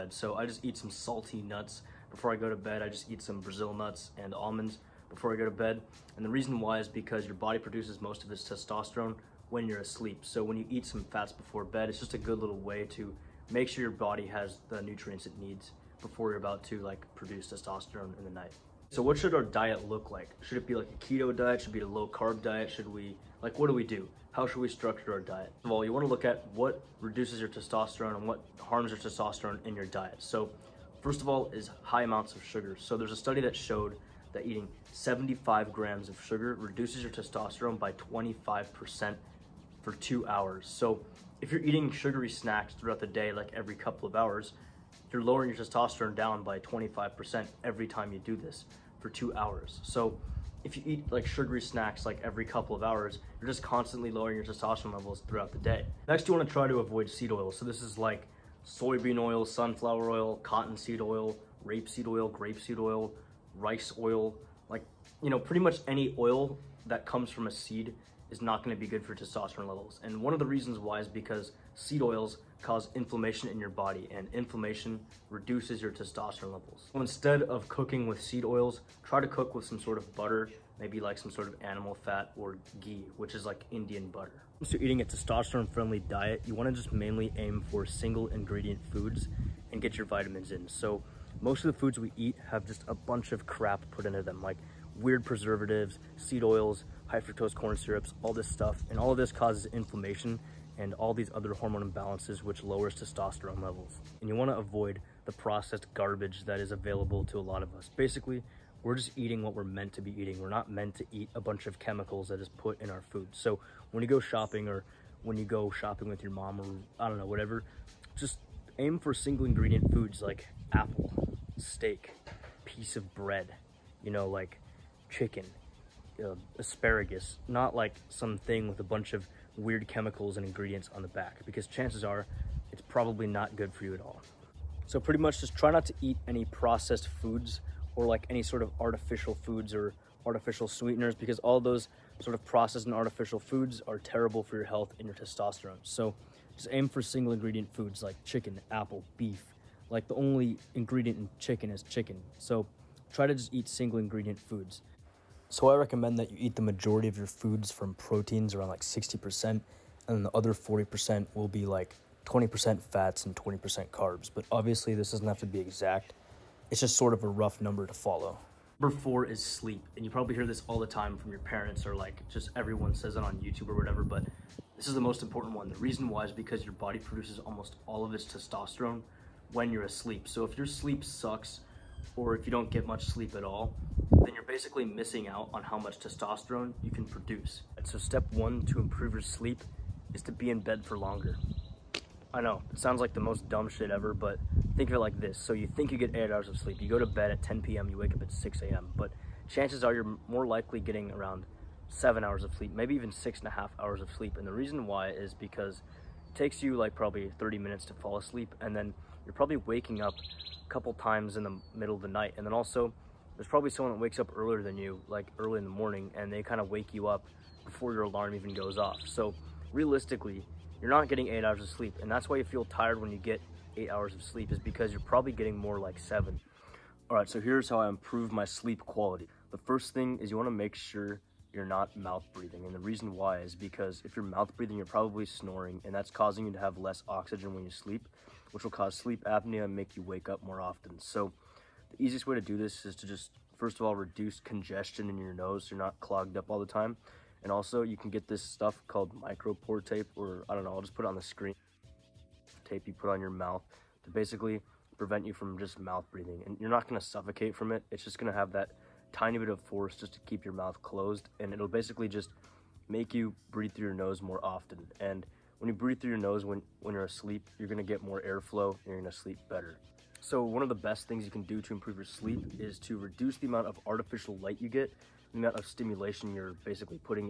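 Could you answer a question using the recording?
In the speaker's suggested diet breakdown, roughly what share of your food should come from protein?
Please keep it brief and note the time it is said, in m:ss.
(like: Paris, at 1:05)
60%, at 2:38.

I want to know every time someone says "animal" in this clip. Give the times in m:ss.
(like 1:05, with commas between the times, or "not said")
1:21.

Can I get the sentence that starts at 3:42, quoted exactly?
And that's why you feel tired when you get eight hours of sleep is because you're probably getting more like seven.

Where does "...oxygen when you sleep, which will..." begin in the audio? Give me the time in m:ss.
3:57.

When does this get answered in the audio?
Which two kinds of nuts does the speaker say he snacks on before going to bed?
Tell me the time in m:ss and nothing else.
0:03.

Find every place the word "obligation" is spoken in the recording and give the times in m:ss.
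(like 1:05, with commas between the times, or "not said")
not said.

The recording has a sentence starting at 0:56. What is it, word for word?
Next, you wanna try to avoid seed oil.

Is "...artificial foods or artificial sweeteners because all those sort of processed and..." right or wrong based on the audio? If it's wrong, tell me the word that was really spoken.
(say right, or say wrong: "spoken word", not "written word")
right.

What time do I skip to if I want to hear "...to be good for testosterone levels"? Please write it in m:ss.
1:08.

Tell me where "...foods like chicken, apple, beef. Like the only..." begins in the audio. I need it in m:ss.
2:27.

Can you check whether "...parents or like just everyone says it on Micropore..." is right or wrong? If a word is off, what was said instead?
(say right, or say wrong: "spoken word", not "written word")
wrong: "YouTube", not "Micropore".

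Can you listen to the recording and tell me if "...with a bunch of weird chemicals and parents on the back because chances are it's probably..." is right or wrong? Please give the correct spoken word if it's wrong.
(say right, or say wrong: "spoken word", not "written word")
wrong: "ingredients", not "parents".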